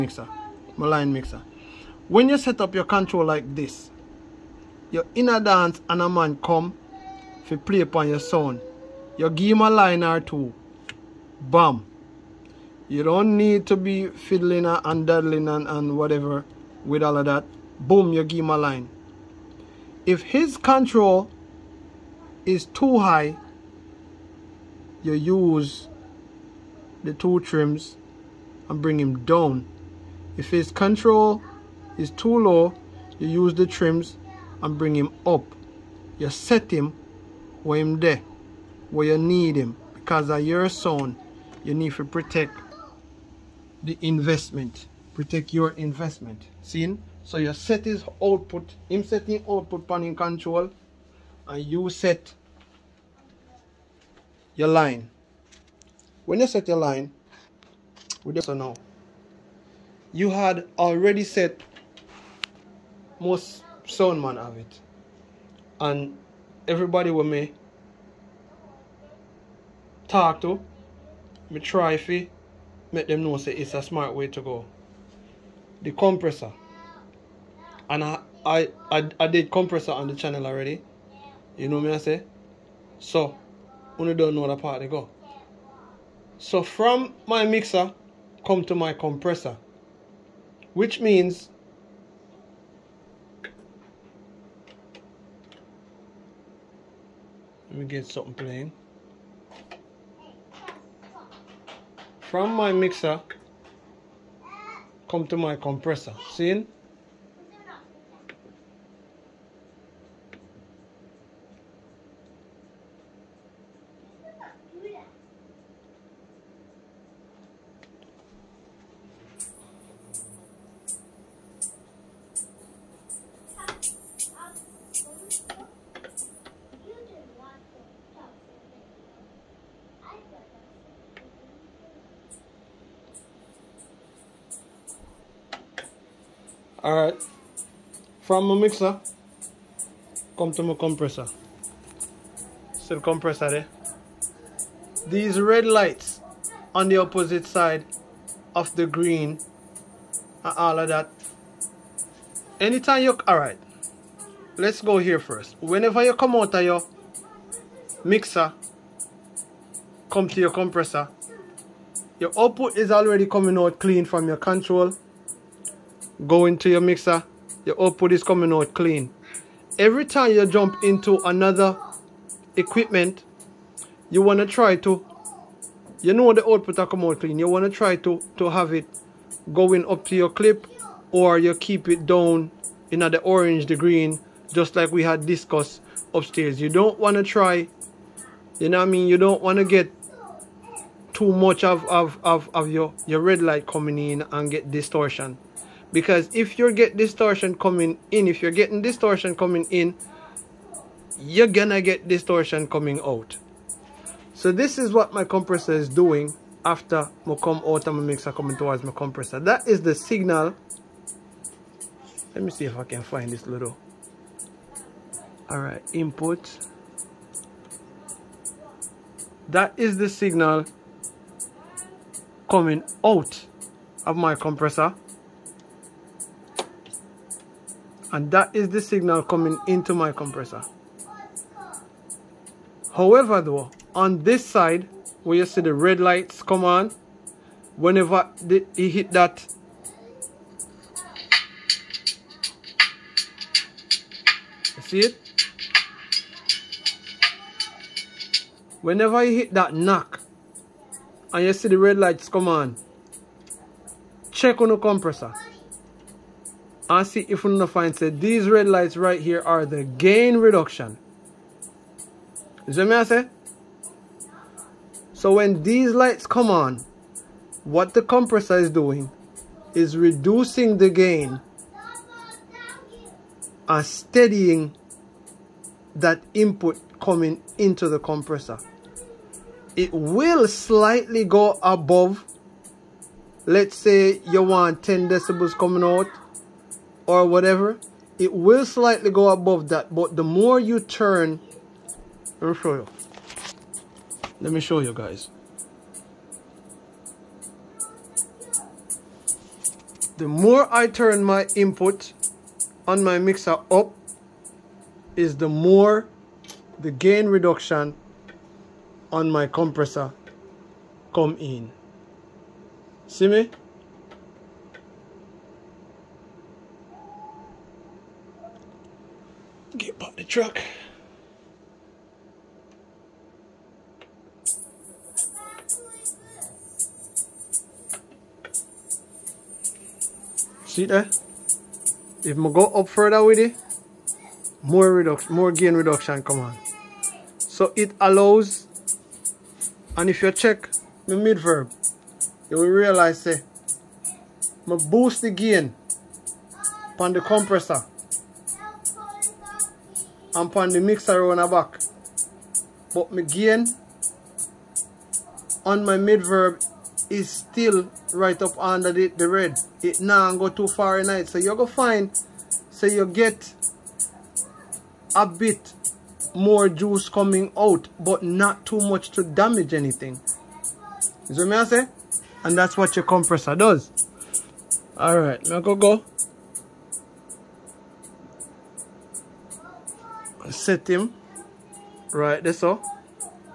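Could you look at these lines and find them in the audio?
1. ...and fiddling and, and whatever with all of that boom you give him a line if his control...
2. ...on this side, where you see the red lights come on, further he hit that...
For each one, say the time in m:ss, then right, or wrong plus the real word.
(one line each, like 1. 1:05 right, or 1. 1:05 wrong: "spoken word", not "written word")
1. 0:14 wrong: "daddling", not "fiddling"
2. 3:53 wrong: "whenever", not "further".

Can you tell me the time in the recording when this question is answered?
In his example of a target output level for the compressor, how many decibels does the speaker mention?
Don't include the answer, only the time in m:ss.
4:44.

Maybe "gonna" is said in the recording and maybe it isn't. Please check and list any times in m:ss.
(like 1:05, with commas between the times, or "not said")
3:21, 6:01.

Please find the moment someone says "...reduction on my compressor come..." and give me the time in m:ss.
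5:07.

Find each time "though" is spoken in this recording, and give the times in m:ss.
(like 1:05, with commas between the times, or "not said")
3:53.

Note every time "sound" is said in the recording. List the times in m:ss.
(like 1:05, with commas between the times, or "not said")
0:08, 0:40, 1:03.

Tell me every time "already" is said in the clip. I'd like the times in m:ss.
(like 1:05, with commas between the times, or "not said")
1:00, 1:20, 2:42.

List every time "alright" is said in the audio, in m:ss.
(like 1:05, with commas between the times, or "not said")
3:35, 6:14.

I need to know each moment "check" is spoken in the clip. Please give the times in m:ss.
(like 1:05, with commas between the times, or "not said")
4:14, 5:40.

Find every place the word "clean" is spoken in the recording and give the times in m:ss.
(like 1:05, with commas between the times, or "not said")
2:43, 2:48, 2:57.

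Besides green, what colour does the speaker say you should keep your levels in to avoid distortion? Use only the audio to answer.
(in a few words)
Orange.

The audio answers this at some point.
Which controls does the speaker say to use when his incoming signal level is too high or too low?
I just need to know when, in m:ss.
0:27.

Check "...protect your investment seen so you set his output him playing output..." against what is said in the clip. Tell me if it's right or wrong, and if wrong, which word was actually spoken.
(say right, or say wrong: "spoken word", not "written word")
wrong: "setting", not "playing".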